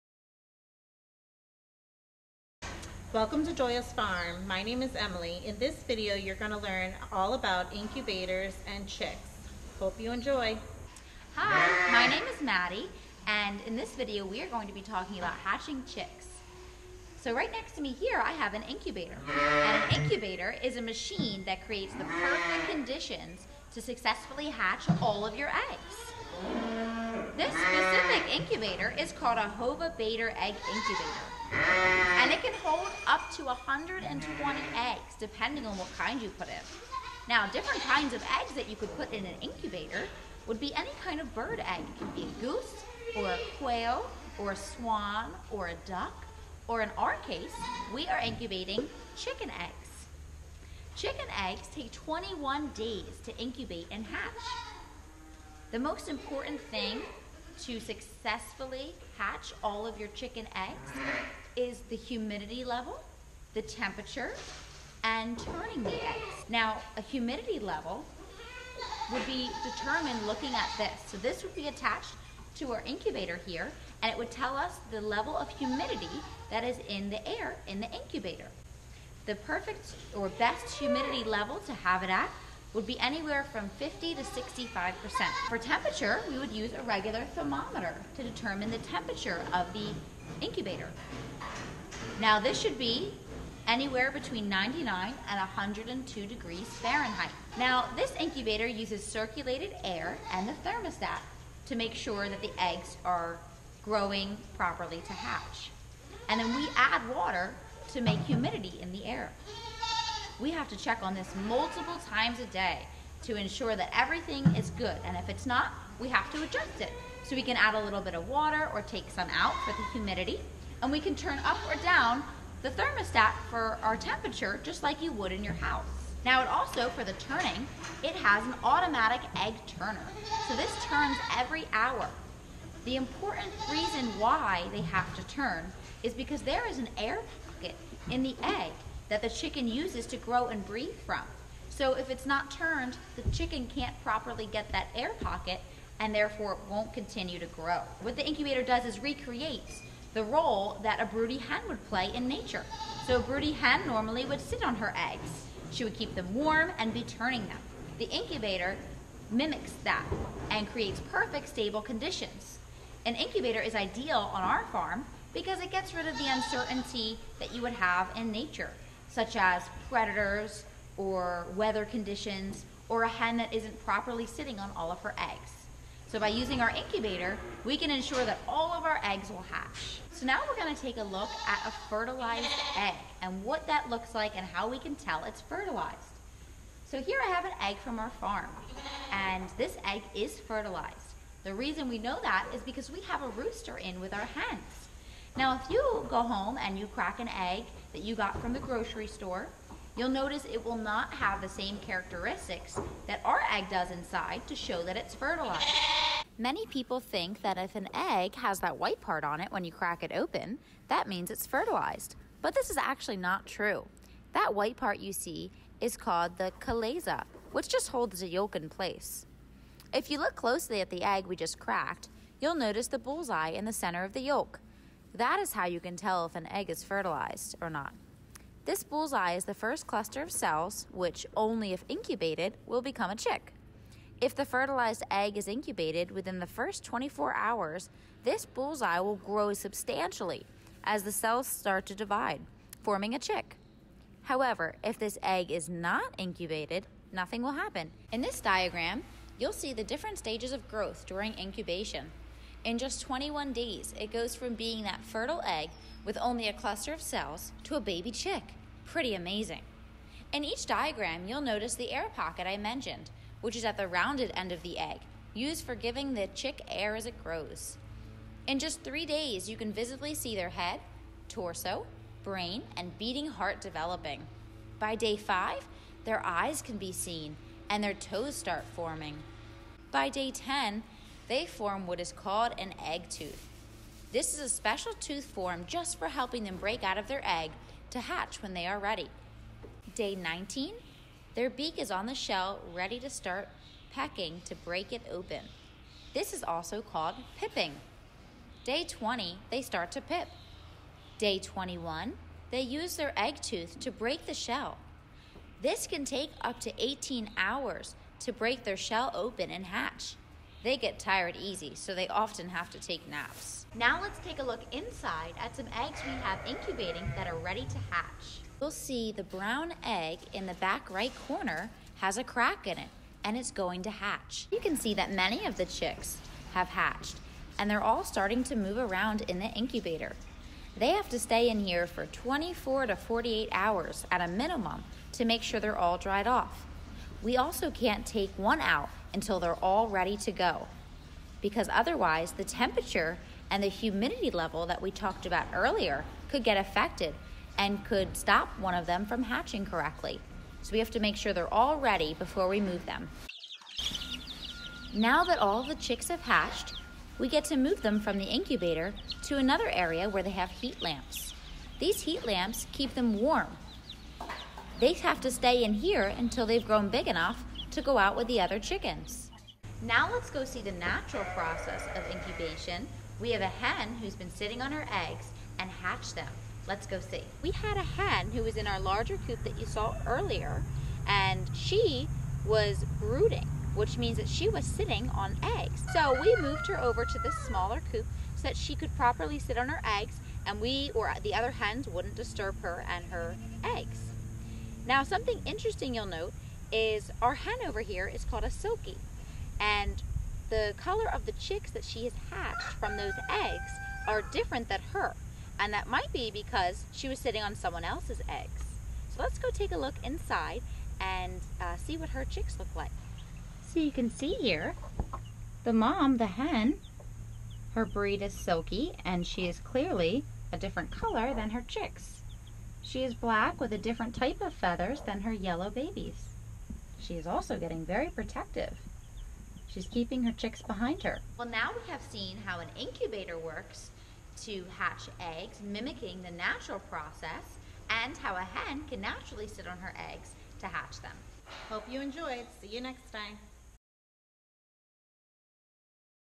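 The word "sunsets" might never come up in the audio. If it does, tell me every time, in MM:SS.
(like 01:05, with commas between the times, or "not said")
not said.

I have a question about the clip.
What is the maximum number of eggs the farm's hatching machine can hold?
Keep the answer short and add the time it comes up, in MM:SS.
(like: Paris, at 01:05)
120, at 00:33.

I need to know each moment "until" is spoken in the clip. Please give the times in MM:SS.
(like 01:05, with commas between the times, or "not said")
05:39, 06:06.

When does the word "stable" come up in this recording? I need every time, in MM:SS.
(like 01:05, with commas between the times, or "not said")
02:41.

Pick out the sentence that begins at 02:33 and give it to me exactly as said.
So a broody hen normally would sit on her eggs.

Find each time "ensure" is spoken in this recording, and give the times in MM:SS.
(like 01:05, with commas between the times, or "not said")
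01:53, 02:57.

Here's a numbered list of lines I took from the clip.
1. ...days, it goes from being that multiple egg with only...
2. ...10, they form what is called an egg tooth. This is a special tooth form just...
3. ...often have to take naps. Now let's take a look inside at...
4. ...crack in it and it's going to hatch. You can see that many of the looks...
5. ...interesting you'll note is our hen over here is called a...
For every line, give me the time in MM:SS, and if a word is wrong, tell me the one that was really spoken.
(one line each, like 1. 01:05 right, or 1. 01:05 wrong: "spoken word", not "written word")
1. 04:13 wrong: "fertile", not "multiple"
2. 04:40 right
3. 05:12 right
4. 05:22 wrong: "chicks", not "looks"
5. 06:35 right.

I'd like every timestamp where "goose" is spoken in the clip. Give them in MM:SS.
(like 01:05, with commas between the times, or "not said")
00:42.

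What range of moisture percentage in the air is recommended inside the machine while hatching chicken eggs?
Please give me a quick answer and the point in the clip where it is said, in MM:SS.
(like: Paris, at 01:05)
50 to 65%, at 01:23.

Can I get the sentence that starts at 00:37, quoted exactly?
Now, different kinds of eggs that you could put in an incubator would be any kind of bird egg.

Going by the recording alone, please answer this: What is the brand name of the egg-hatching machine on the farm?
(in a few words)
Hova-Bator.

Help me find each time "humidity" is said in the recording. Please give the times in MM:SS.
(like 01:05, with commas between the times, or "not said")
01:01, 01:07, 01:15, 01:20, 01:48, 01:59, 05:43.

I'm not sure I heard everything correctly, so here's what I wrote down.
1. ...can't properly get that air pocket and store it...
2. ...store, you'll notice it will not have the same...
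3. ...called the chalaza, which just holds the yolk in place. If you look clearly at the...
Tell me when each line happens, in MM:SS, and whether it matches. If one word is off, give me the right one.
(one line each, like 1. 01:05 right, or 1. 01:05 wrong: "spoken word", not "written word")
1. 02:23 wrong: "therefore", not "store"
2. 03:19 right
3. 03:35 wrong: "closely", not "clearly".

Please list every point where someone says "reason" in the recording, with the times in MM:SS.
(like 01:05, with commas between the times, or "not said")
02:13, 03:11.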